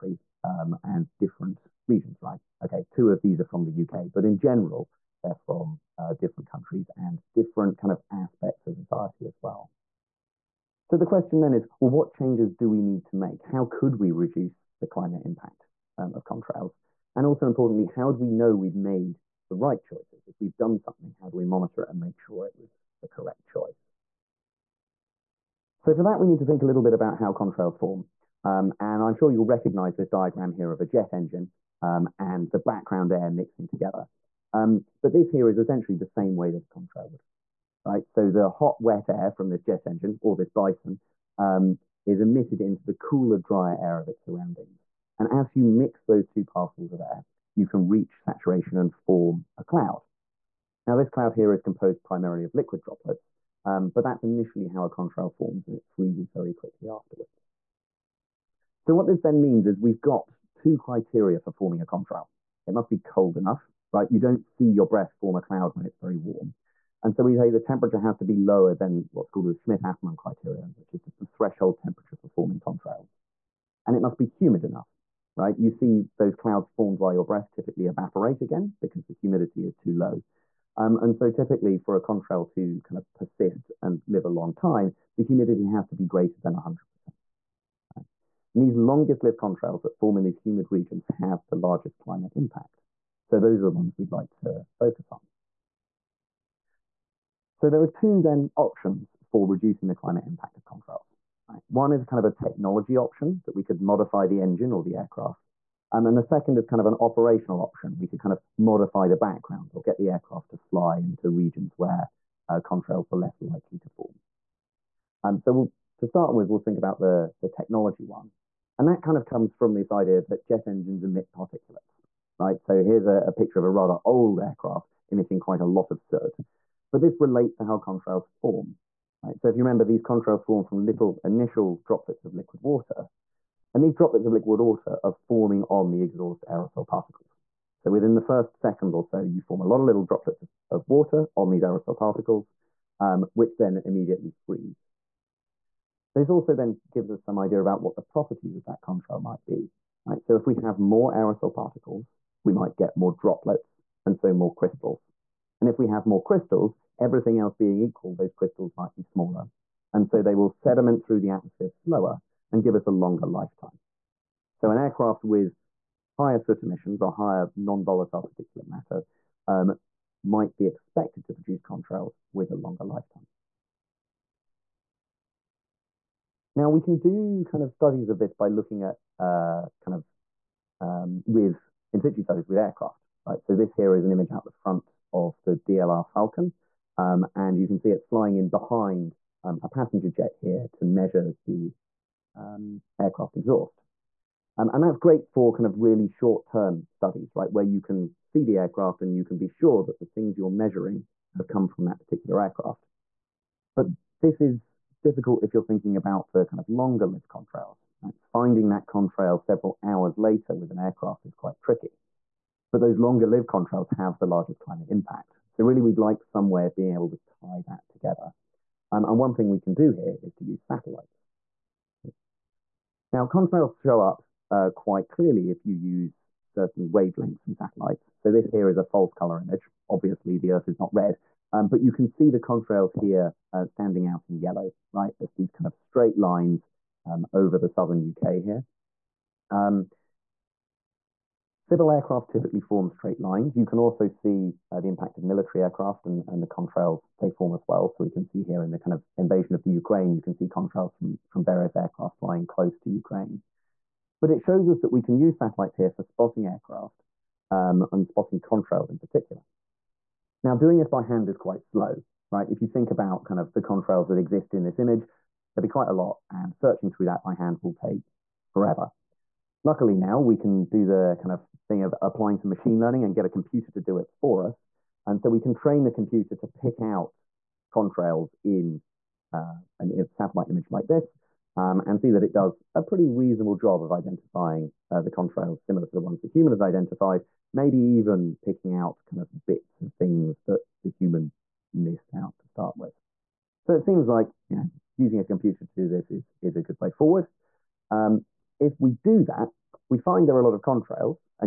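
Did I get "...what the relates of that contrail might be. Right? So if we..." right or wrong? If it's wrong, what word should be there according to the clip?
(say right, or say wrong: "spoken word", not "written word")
wrong: "properties", not "relates".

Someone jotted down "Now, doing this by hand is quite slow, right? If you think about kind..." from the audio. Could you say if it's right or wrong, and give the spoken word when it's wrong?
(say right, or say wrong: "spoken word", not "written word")
right.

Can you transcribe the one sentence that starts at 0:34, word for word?
Um, but this here is essentially the same way that a contrail would, right?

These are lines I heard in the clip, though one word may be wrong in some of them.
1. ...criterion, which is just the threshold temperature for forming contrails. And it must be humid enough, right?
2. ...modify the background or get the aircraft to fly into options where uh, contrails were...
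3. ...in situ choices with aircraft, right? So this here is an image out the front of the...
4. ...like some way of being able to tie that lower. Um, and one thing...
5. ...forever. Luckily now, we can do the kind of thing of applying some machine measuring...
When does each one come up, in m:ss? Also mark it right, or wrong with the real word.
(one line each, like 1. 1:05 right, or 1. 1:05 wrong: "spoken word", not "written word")
1. 1:10 right
2. 1:48 wrong: "regions", not "options"
3. 3:01 wrong: "studies", not "choices"
4. 3:35 wrong: "together", not "lower"
5. 4:28 wrong: "learning", not "measuring".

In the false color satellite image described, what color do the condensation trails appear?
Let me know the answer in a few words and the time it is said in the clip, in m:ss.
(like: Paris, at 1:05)
yellow, at 3:54.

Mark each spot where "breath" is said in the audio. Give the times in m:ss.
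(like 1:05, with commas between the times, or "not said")
1:04, 1:17.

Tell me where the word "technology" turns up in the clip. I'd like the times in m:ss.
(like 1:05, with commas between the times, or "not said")
1:42, 1:57.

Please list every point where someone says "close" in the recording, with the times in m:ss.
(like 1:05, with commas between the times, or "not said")
4:12.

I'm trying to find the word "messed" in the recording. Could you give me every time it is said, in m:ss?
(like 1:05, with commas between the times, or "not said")
not said.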